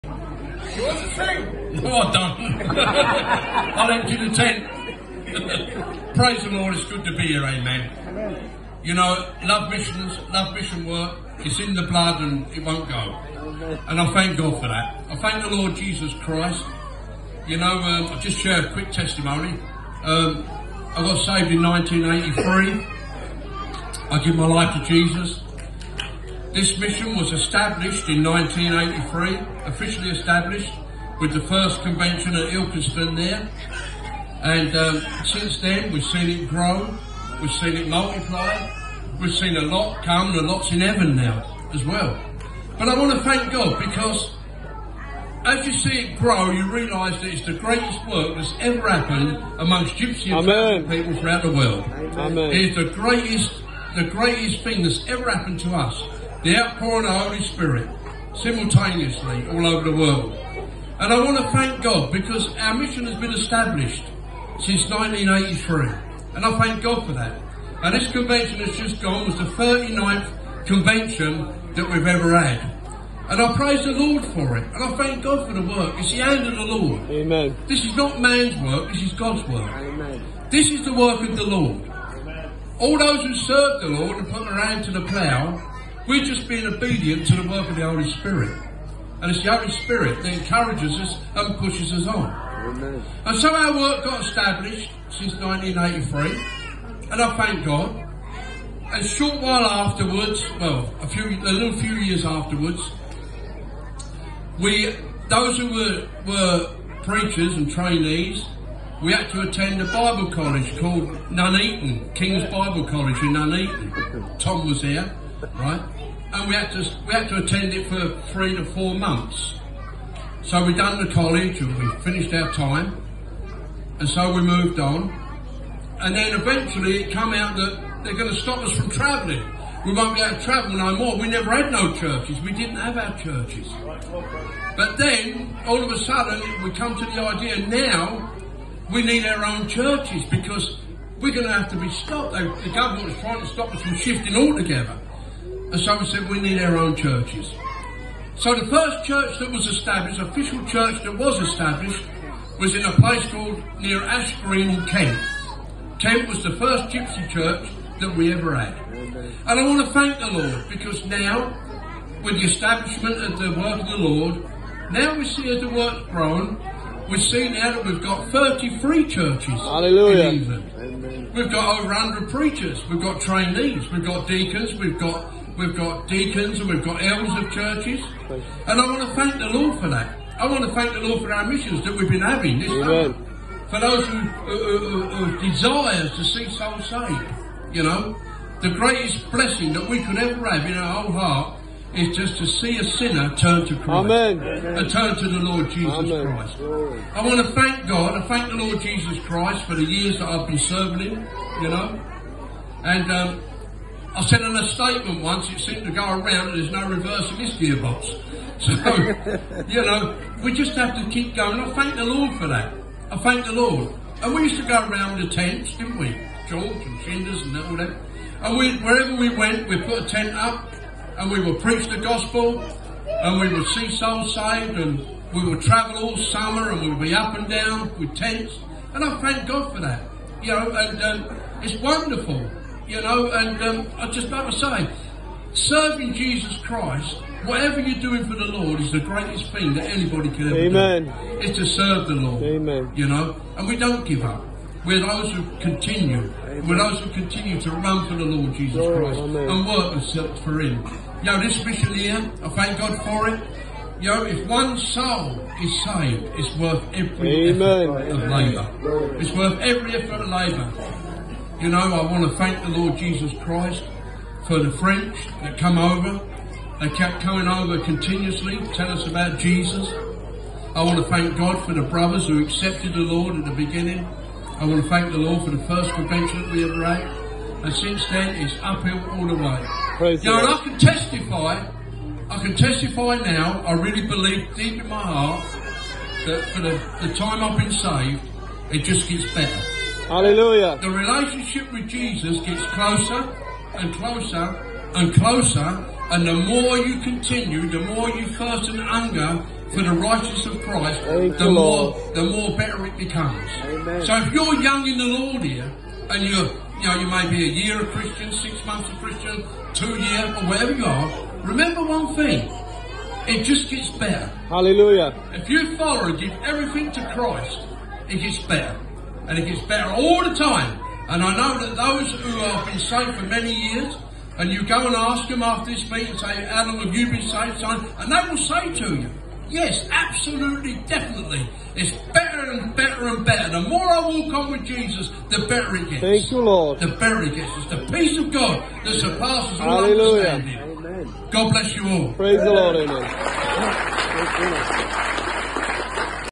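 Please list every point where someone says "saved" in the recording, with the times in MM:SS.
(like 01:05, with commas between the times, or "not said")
00:01, 00:21, 03:06, 03:44, 04:15, 04:47, 05:22, 05:27.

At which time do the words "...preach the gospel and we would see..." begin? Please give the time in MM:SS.
03:41.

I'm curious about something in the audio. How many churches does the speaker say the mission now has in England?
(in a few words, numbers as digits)
33.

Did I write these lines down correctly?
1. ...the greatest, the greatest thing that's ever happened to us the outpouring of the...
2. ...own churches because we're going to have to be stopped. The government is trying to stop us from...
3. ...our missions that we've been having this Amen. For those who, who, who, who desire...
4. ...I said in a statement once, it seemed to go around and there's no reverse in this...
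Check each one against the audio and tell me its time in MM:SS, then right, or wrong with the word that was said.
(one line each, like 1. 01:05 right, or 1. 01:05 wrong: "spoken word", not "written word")
1. 00:52 right
2. 02:19 right
3. 03:01 right
4. 03:24 right.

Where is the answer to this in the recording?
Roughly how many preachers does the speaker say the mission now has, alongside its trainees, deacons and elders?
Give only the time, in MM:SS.
02:51.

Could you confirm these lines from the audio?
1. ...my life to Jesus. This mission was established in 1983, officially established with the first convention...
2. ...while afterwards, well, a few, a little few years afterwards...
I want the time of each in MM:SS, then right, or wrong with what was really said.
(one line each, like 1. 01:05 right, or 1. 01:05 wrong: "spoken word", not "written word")
1. 00:24 right
2. 01:39 right.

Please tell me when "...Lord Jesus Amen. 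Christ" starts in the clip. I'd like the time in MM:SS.
03:15.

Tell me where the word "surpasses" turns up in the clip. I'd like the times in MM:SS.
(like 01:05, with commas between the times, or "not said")
05:38.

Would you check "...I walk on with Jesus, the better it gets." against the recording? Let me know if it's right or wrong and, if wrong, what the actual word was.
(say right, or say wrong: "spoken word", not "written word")
right.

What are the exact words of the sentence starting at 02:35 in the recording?
Kent was the first gypsy church that we ever had.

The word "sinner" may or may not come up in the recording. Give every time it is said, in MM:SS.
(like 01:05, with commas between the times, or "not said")
03:12.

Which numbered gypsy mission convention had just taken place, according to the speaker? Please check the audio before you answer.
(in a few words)
39th.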